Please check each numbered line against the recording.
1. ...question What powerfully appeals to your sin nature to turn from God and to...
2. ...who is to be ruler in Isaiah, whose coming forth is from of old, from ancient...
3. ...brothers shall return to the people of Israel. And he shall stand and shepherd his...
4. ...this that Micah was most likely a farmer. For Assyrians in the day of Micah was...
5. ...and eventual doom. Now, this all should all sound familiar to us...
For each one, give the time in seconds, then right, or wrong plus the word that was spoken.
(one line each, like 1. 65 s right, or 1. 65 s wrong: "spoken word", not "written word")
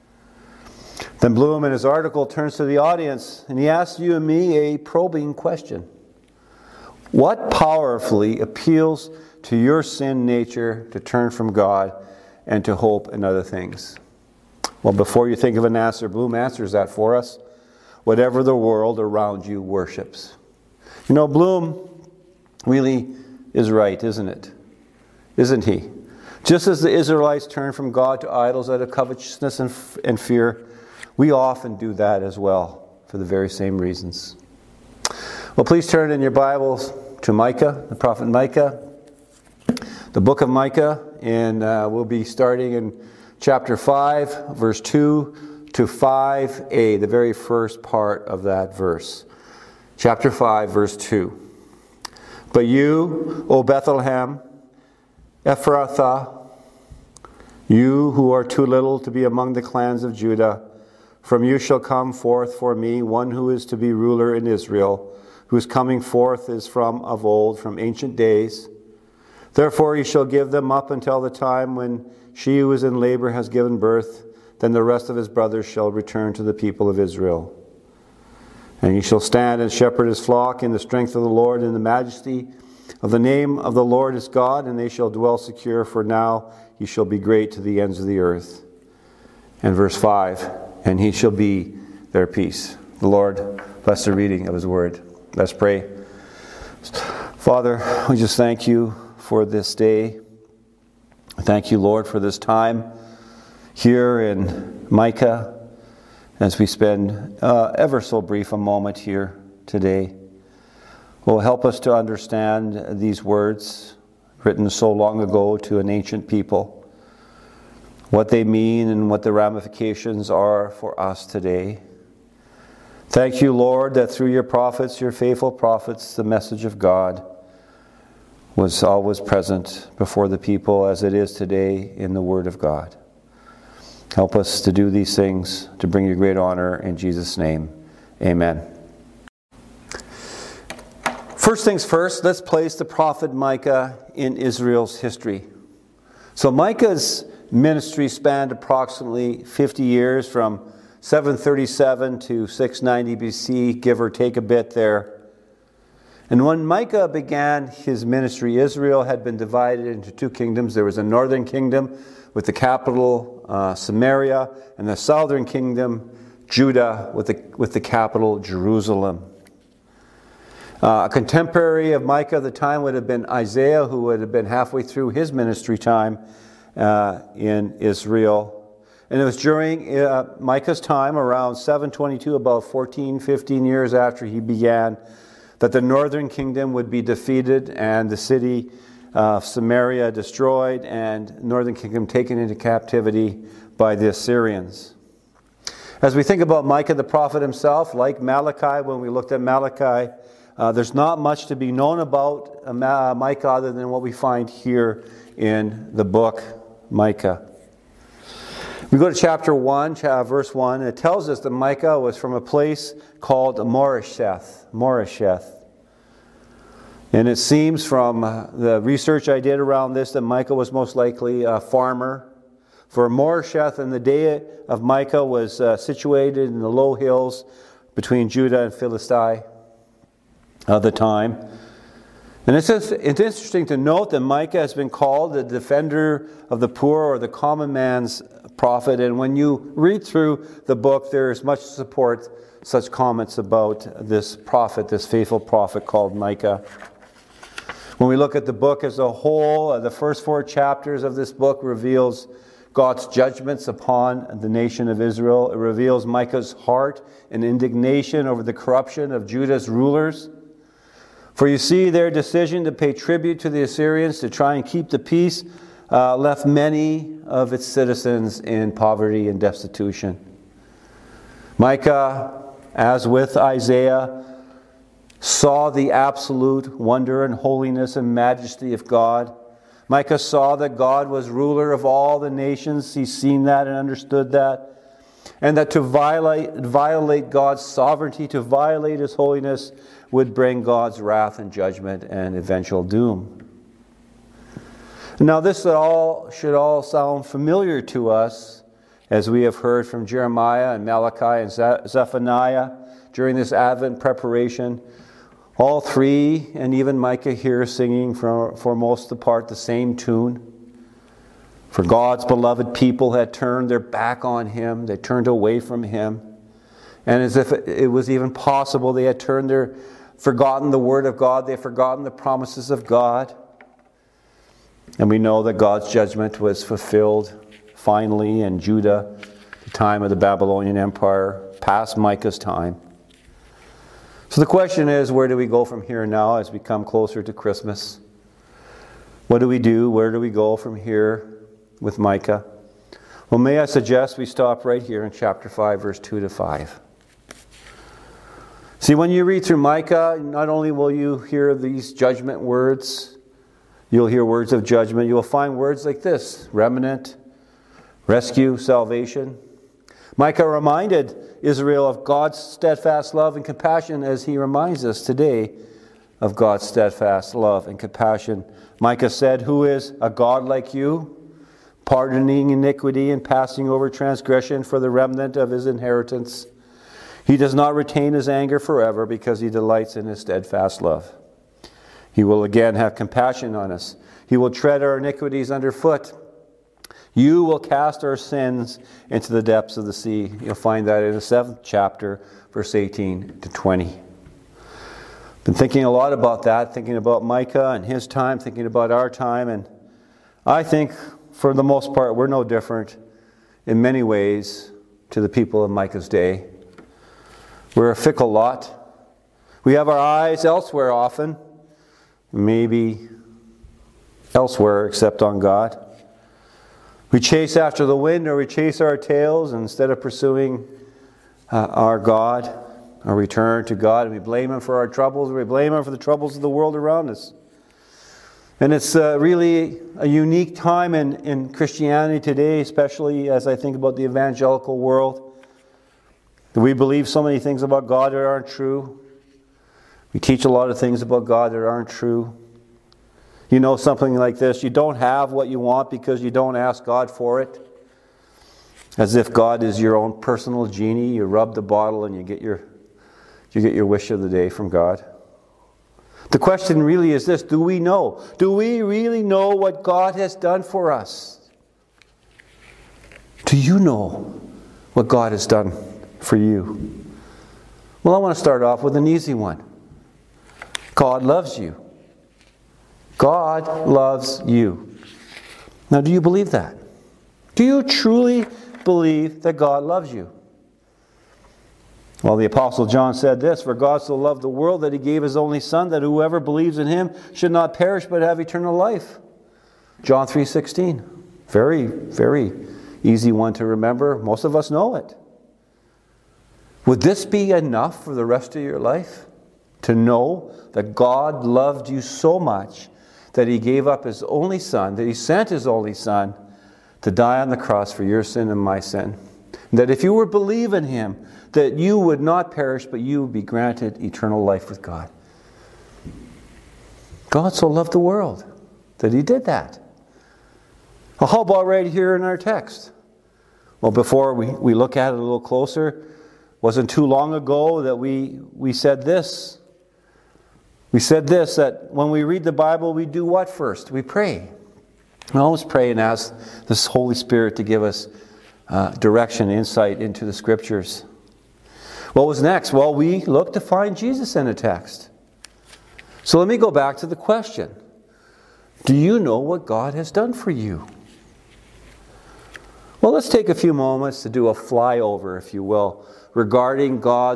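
1. 5 s right
2. 63 s wrong: "Israel", not "Isaiah"
3. 75 s right
4. 219 s wrong: "Moresheth", not "Assyrians"
5. 292 s right.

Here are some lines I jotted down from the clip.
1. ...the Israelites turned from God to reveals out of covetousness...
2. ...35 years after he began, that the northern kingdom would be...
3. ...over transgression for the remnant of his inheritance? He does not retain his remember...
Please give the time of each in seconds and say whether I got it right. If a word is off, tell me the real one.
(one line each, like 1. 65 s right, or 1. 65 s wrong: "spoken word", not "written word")
1. 26 s wrong: "idols", not "reveals"
2. 183 s wrong: "15", not "35"
3. 373 s wrong: "anger", not "remember".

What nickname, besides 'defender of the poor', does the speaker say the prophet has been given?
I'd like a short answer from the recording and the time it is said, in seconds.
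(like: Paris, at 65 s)
The common man's prophet, at 237 s.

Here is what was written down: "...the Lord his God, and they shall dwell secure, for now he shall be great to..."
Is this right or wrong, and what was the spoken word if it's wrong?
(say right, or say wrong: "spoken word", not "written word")
right.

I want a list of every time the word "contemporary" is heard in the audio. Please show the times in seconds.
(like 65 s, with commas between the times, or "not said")
171 s.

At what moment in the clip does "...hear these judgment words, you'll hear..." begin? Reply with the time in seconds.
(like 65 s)
351 s.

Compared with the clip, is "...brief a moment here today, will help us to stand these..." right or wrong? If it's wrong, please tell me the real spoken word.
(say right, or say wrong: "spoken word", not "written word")
wrong: "understand", not "stand".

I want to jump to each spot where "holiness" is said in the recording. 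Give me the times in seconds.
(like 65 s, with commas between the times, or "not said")
277 s, 289 s.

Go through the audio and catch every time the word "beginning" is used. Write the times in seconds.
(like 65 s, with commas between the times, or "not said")
not said.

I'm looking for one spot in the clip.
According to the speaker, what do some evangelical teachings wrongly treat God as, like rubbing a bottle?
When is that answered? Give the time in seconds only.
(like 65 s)
449 s.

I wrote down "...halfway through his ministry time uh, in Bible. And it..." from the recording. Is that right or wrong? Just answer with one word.
wrong.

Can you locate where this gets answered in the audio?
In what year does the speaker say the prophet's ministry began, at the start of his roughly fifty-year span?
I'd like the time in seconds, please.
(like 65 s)
150 s.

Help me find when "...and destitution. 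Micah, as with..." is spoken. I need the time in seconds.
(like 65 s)
269 s.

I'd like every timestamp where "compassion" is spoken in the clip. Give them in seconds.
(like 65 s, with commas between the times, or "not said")
363 s, 367 s, 382 s.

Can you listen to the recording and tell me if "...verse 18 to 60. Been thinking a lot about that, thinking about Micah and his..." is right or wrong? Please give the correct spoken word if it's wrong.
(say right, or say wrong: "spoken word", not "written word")
wrong: "20", not "60".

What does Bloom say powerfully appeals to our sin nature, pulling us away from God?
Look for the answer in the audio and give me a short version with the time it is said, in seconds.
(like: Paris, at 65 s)
Whatever the world around you worships, at 18 s.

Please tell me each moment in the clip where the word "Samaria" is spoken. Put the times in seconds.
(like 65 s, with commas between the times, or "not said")
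163 s, 189 s.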